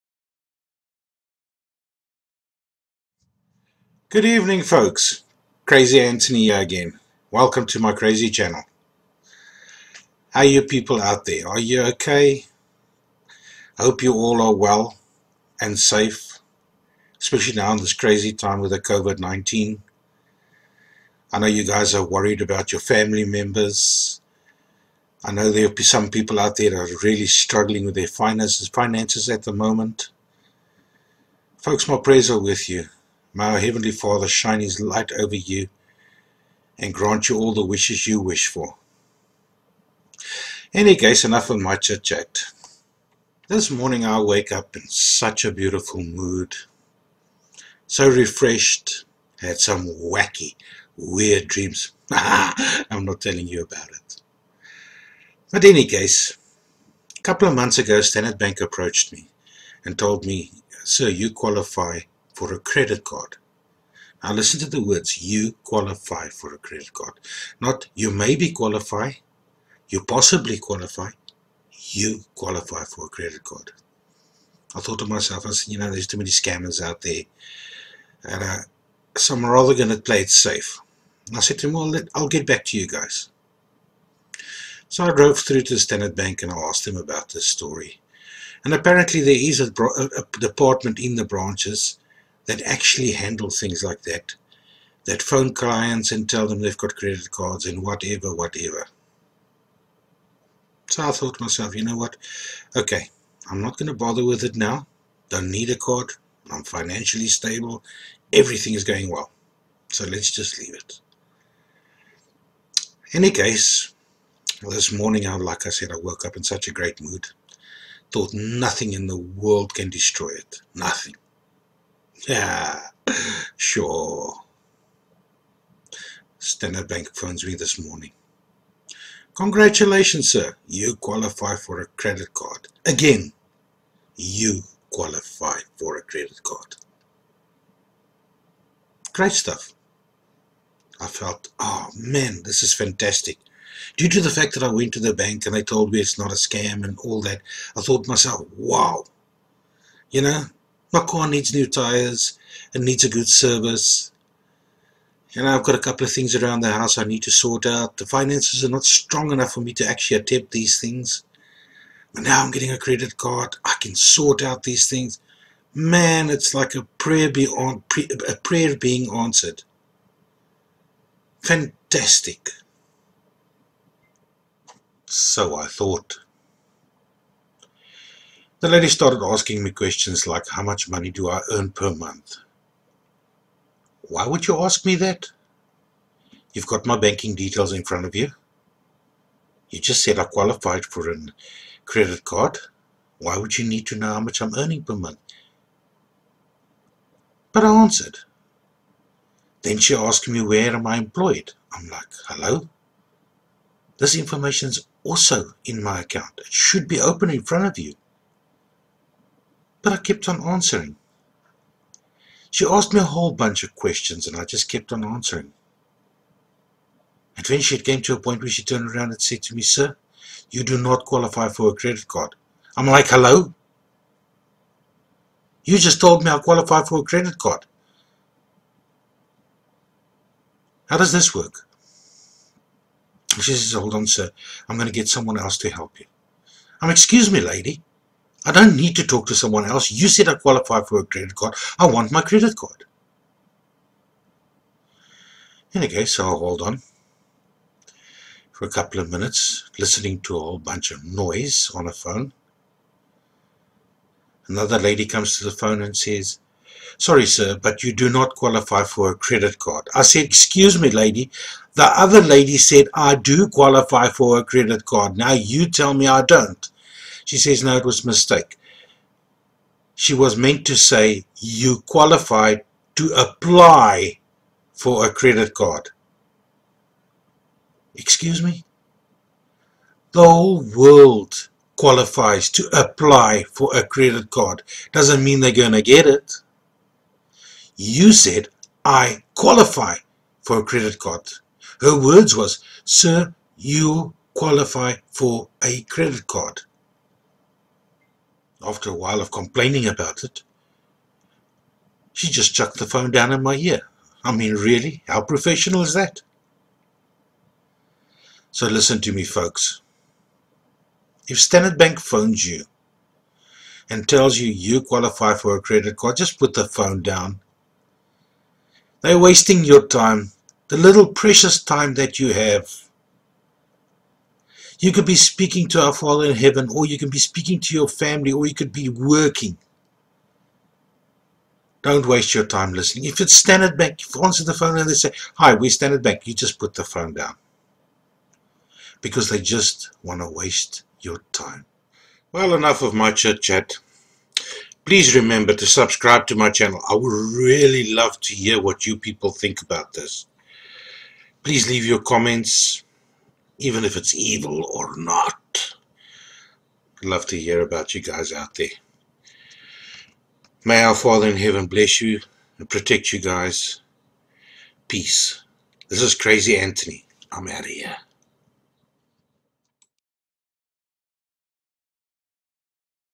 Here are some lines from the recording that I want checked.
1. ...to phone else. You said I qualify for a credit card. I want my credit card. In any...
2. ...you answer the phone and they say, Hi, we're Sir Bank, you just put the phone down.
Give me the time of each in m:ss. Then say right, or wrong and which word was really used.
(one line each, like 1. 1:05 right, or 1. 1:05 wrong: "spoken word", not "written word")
1. 3:59 wrong: "someone", not "phone"
2. 5:34 wrong: "Standard", not "Sir".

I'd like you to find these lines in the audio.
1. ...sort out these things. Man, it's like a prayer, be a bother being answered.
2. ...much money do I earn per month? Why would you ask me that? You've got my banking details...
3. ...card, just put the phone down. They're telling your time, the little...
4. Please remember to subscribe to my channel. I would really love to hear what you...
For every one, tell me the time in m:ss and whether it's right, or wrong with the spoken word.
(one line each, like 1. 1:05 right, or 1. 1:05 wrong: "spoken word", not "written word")
1. 2:43 wrong: "prayer", not "bother"
2. 3:00 right
3. 5:15 wrong: "wasting", not "telling"
4. 5:44 right.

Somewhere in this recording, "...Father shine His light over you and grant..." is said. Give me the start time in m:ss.
0:33.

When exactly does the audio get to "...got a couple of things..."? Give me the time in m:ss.
2:35.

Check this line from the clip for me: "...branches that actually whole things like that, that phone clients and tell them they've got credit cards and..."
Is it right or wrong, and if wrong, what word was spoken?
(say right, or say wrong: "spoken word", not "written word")
wrong: "handle", not "whole".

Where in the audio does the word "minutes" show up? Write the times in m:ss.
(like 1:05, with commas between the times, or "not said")
4:09.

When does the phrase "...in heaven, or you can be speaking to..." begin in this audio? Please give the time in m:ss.
5:26.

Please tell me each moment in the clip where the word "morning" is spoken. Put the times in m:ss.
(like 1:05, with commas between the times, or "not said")
0:43, 1:54, 2:07.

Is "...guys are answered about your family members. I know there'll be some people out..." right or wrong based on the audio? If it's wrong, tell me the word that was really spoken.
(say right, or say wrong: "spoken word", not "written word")
wrong: "worried", not "answered".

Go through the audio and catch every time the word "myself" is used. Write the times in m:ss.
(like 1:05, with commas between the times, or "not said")
1:15, 1:41, 2:28.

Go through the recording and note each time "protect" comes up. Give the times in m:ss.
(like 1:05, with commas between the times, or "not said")
6:02.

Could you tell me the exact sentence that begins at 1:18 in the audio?
And uh, so i rather going to play it safe.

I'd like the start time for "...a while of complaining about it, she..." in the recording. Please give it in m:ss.
4:58.